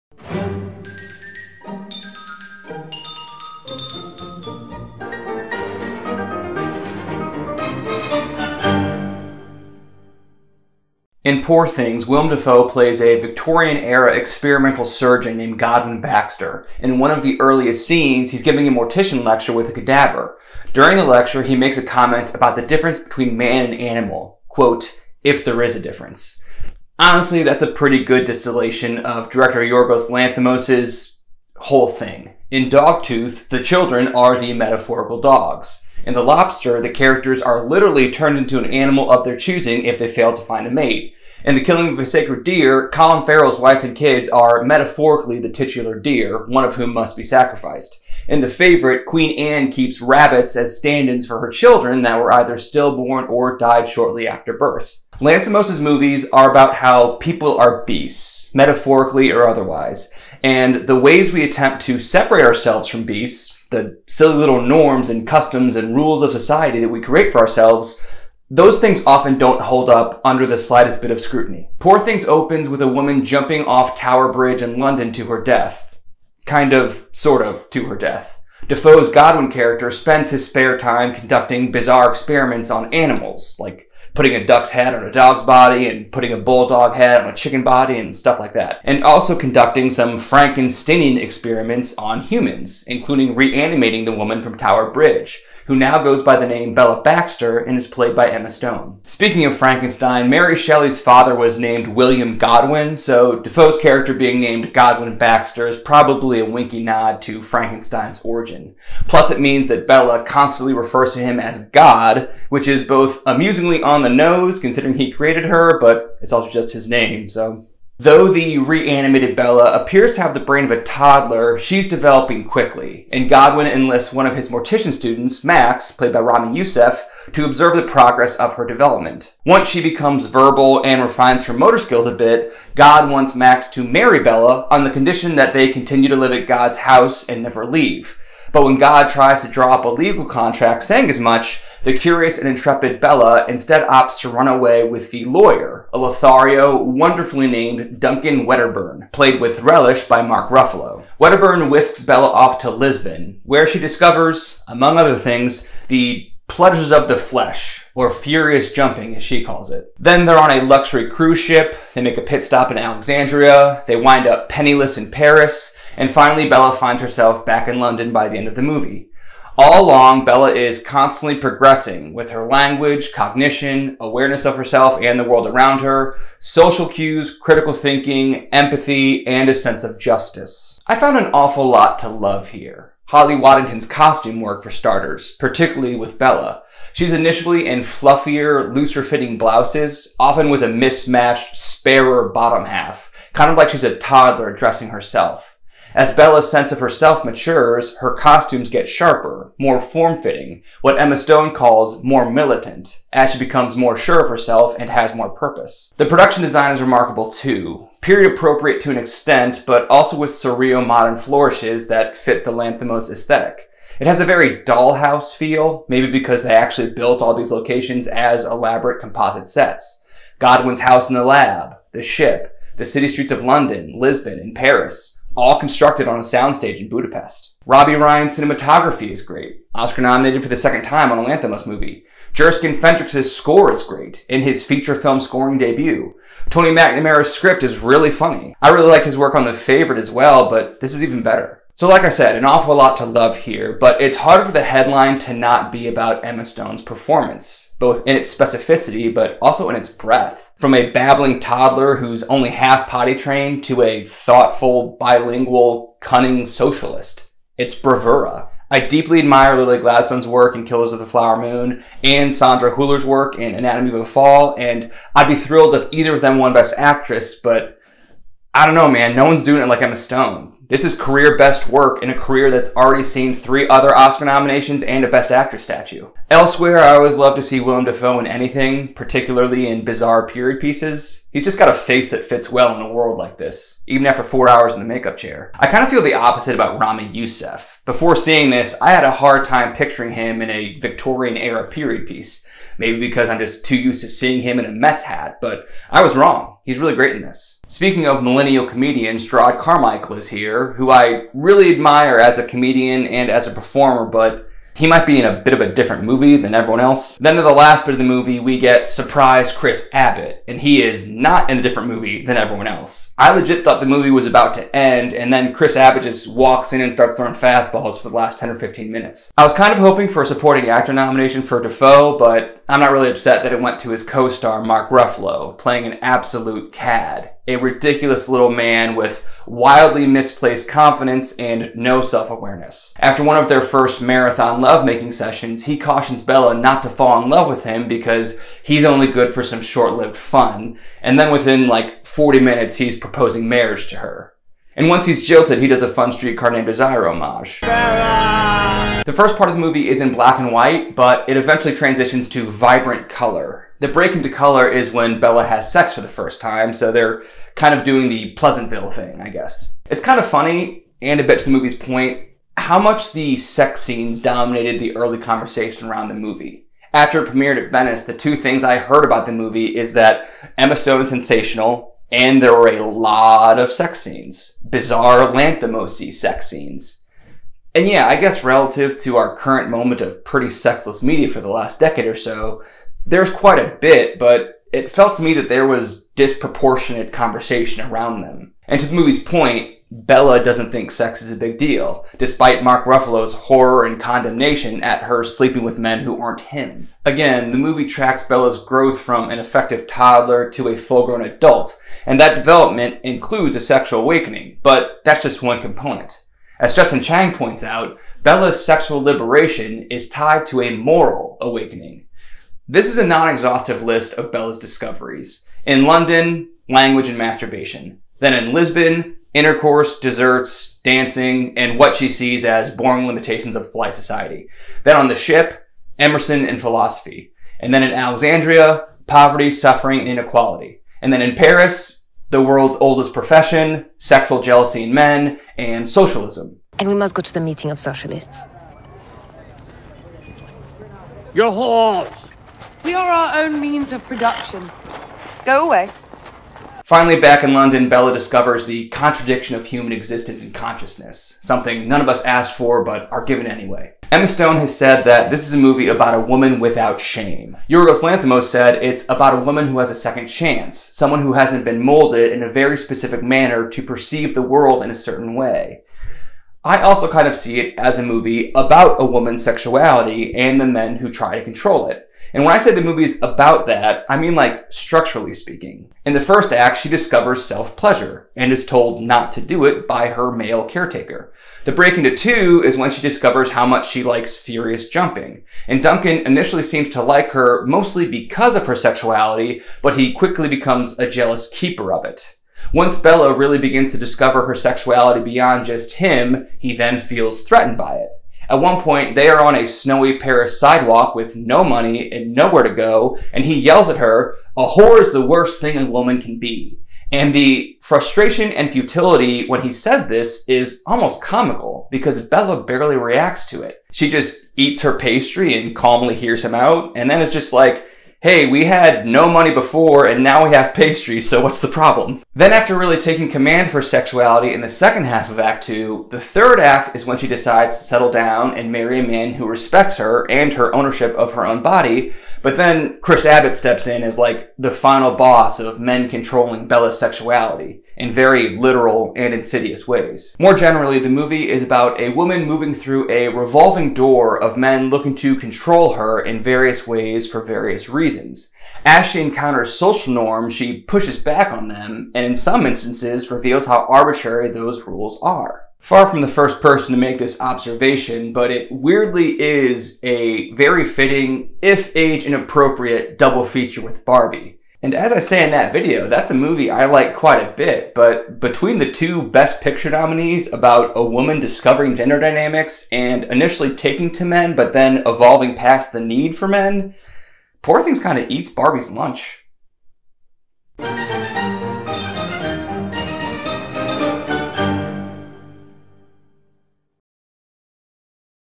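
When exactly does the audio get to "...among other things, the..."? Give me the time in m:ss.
2:34.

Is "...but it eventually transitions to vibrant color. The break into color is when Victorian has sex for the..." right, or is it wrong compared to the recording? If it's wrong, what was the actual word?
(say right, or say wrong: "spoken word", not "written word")
wrong: "Bella", not "Victorian".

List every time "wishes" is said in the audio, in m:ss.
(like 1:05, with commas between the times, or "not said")
not said.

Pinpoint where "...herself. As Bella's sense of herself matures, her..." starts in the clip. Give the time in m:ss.
3:14.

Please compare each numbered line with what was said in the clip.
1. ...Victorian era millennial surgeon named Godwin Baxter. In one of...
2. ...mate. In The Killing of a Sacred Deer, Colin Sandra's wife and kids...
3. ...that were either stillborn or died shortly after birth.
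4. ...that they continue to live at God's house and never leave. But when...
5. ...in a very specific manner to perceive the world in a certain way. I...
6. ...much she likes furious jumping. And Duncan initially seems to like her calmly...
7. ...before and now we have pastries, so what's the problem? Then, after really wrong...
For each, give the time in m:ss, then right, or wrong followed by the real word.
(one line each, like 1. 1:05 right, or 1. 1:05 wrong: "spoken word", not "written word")
1. 0:13 wrong: "experimental", not "millennial"
2. 0:40 wrong: "Farrell", not "Sandra"
3. 0:52 right
4. 2:15 right
5. 7:42 right
6. 8:03 wrong: "mostly", not "calmly"
7. 8:39 wrong: "taking", not "wrong".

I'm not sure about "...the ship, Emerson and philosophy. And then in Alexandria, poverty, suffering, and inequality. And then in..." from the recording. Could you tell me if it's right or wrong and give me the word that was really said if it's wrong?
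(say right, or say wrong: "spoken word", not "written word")
right.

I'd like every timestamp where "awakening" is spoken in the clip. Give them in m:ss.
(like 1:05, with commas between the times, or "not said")
6:44, 6:51.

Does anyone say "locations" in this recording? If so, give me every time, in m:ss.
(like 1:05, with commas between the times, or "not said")
3:37.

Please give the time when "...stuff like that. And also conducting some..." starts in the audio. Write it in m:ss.
1:28.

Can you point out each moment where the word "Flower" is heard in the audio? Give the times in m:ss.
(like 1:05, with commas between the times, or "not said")
4:21.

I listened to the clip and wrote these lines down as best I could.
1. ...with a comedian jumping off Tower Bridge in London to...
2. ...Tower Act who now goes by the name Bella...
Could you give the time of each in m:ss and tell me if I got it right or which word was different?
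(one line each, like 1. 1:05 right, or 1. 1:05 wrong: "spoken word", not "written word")
1. 1:12 wrong: "woman", not "comedian"
2. 1:34 wrong: "Bridge", not "Act".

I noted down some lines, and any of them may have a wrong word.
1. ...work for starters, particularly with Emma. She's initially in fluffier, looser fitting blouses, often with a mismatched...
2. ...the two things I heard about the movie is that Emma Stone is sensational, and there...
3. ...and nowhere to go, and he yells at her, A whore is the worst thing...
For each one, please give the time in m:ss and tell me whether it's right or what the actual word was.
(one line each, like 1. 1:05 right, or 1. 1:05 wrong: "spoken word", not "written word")
1. 3:04 wrong: "Bella", not "Emma"
2. 6:08 right
3. 8:22 right.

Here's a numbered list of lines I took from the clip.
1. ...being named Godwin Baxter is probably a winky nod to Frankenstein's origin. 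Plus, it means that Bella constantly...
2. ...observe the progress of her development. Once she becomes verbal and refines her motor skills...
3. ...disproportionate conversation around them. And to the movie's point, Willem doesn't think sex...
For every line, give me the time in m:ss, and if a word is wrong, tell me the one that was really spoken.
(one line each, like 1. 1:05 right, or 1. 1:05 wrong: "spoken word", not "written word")
1. 1:44 right
2. 2:07 right
3. 6:26 wrong: "Bella", not "Willem".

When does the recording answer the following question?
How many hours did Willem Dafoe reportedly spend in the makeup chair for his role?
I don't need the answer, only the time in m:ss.
4:44.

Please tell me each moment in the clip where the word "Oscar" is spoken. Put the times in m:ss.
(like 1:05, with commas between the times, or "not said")
3:49, 4:33.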